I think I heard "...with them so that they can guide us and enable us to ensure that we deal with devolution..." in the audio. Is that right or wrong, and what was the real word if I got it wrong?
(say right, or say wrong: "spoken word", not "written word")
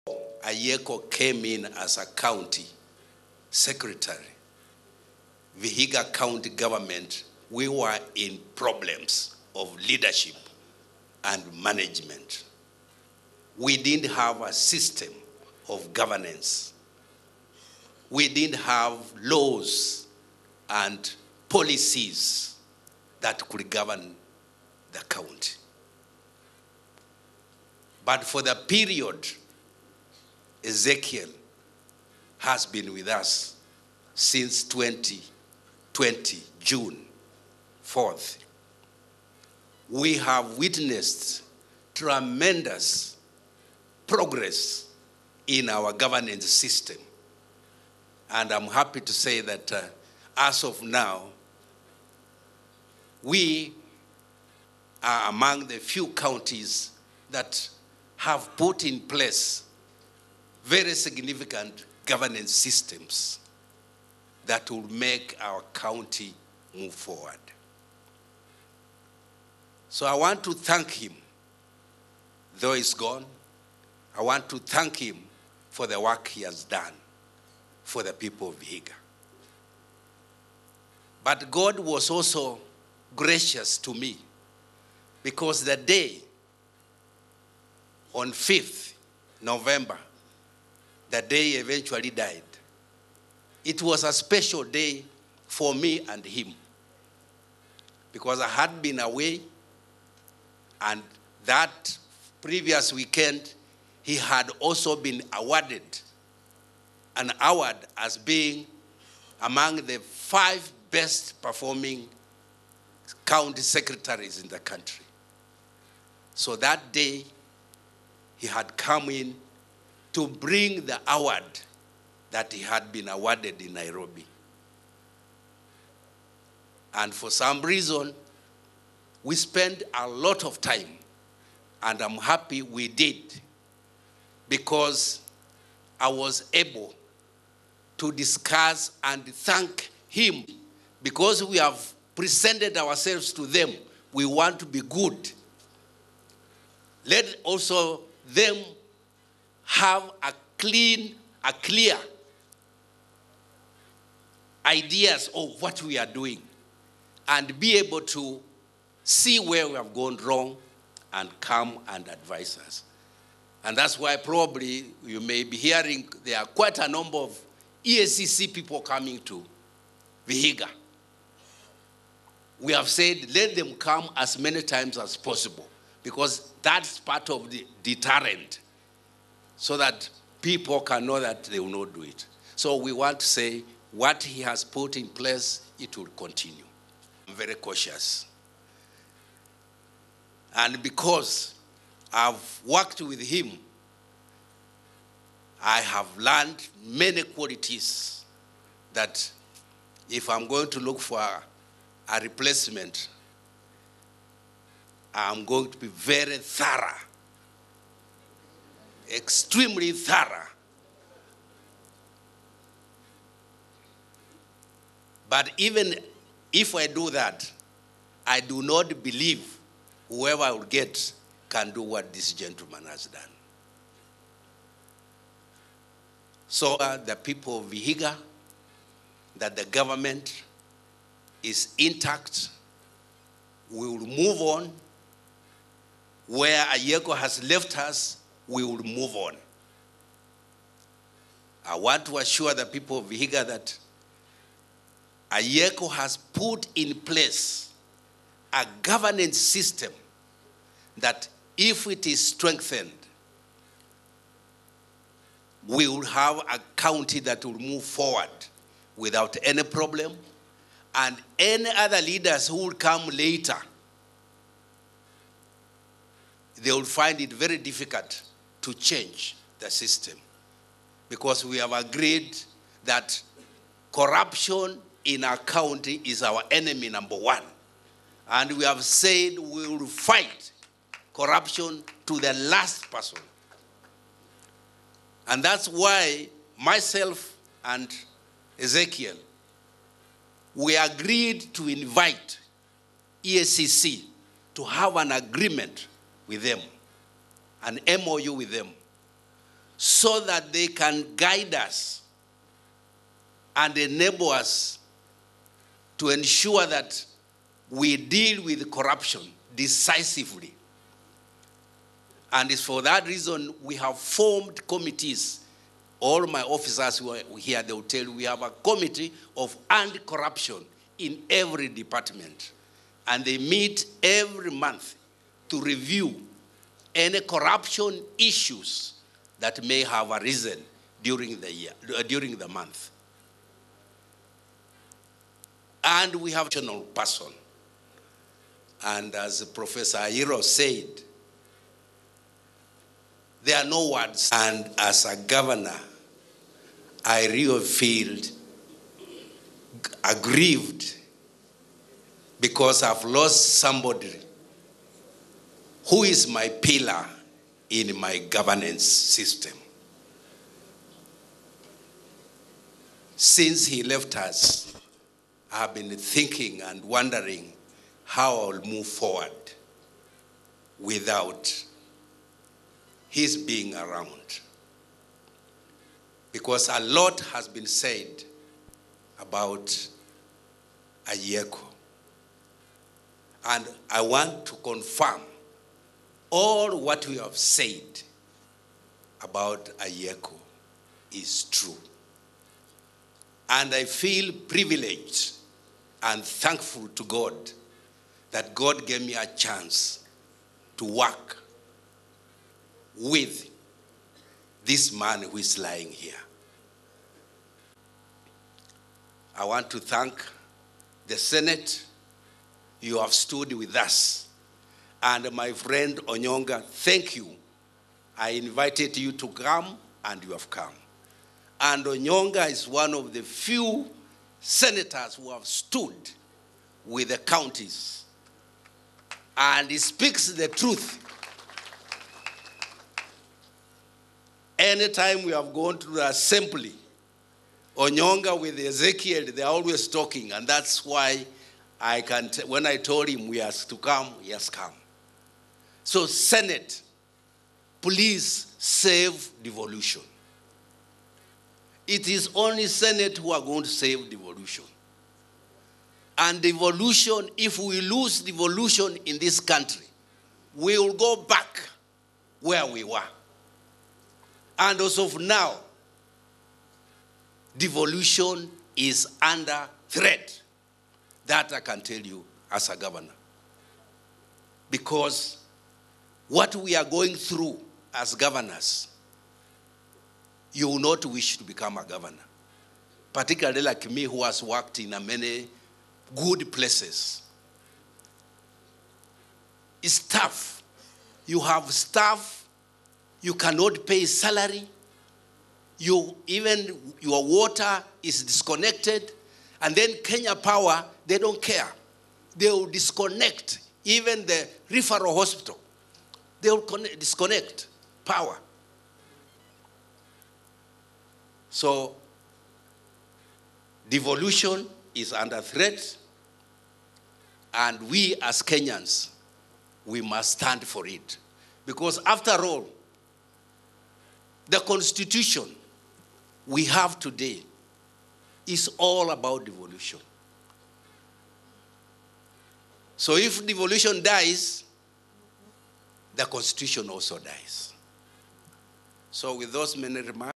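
wrong: "corruption", not "devolution".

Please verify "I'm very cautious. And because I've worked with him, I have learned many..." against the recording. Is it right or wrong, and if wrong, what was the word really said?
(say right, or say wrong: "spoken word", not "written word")
right.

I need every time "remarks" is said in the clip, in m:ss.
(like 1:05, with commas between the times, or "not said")
9:00.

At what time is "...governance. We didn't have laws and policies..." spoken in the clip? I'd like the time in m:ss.
0:15.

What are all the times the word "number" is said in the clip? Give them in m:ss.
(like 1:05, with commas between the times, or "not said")
2:46, 4:36.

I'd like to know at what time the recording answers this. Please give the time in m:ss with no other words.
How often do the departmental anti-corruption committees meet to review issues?
5:24.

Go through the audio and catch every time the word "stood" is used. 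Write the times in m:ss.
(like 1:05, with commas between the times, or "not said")
6:53, 7:05.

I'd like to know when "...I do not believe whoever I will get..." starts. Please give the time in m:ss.
3:38.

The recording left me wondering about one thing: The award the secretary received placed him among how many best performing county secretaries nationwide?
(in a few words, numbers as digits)
5.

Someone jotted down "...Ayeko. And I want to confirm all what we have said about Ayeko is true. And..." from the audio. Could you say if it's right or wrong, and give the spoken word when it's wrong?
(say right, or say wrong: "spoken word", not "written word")
right.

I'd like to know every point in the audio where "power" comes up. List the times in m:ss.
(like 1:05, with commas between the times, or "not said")
8:20, 8:28.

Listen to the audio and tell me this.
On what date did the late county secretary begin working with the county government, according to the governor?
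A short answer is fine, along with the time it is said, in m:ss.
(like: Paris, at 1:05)
June 4th, 2020, at 0:34.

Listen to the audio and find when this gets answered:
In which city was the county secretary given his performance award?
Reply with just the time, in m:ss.
2:03.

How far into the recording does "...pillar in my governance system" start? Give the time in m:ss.
5:56.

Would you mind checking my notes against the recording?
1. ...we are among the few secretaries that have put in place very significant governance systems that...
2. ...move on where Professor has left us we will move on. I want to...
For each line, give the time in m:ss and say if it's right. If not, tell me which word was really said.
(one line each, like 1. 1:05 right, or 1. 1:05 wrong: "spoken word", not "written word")
1. 0:53 wrong: "counties", not "secretaries"
2. 3:54 wrong: "Ayeko", not "Professor".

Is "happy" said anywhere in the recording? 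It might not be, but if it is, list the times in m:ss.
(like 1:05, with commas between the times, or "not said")
0:48, 2:12.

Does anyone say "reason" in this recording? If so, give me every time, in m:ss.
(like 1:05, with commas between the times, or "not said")
2:07, 5:13.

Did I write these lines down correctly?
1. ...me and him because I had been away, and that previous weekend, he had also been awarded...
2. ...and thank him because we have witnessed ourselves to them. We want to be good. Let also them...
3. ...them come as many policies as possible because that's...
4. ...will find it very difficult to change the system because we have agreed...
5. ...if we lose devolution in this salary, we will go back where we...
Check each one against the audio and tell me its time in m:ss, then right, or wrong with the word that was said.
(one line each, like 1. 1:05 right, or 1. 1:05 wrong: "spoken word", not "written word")
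1. 1:35 right
2. 2:19 wrong: "presented", not "witnessed"
3. 2:53 wrong: "times", not "policies"
4. 4:26 right
5. 7:37 wrong: "country", not "salary".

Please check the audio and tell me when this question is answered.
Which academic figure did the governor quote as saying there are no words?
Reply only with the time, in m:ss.
5:39.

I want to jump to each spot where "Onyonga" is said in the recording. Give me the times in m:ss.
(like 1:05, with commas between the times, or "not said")
6:56, 7:01, 7:17.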